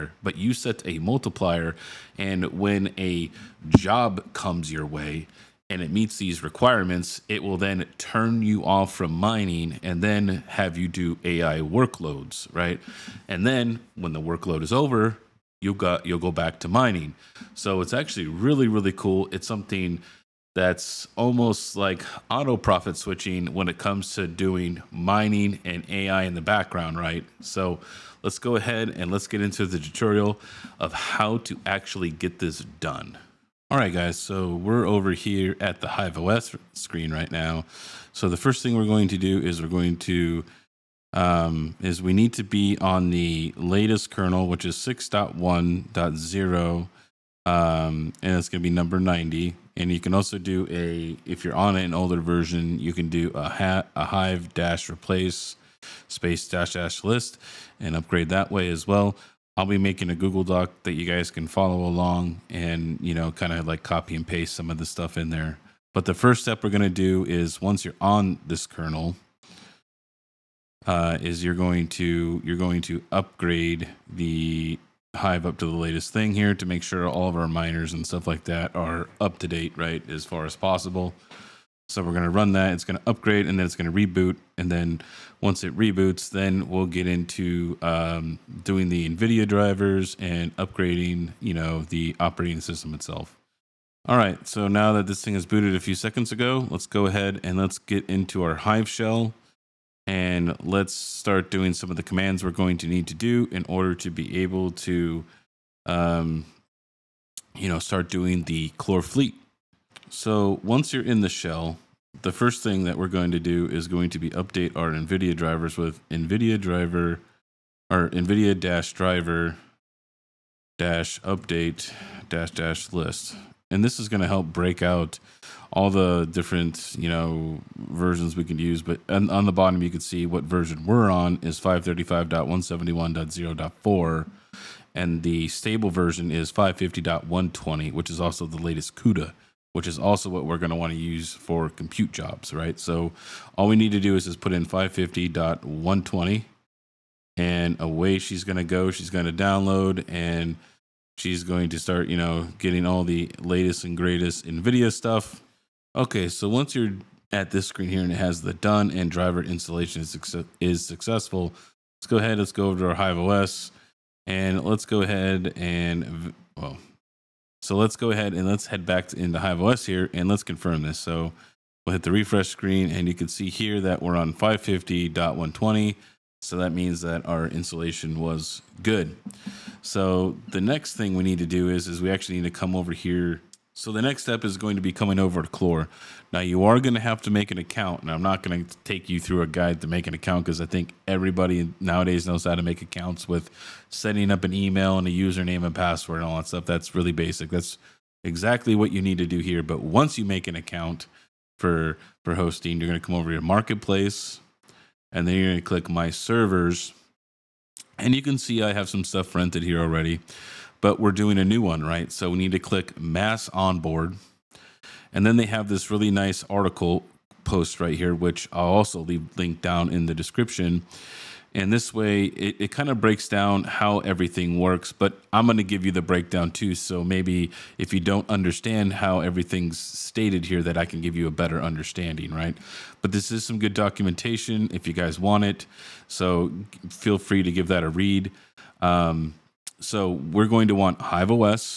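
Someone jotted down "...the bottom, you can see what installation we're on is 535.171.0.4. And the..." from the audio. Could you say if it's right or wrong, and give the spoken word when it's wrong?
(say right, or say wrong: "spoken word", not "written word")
wrong: "version", not "installation".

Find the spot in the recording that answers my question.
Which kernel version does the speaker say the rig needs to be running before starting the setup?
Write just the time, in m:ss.
0:44.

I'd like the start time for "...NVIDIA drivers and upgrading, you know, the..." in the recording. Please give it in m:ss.
1:29.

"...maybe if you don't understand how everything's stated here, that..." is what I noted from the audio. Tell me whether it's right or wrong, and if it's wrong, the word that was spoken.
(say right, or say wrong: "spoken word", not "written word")
right.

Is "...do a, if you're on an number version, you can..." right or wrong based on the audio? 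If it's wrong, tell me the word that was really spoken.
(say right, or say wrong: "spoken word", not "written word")
wrong: "older", not "number".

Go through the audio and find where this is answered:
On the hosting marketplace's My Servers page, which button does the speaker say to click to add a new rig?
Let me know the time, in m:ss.
3:32.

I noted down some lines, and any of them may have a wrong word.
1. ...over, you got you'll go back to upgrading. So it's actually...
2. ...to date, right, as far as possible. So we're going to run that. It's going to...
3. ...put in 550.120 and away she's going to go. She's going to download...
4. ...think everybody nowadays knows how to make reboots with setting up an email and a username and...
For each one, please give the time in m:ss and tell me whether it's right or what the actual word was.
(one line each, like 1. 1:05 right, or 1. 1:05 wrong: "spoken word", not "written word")
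1. 0:14 wrong: "mining", not "upgrading"
2. 1:19 right
3. 2:24 right
4. 3:10 wrong: "accounts", not "reboots".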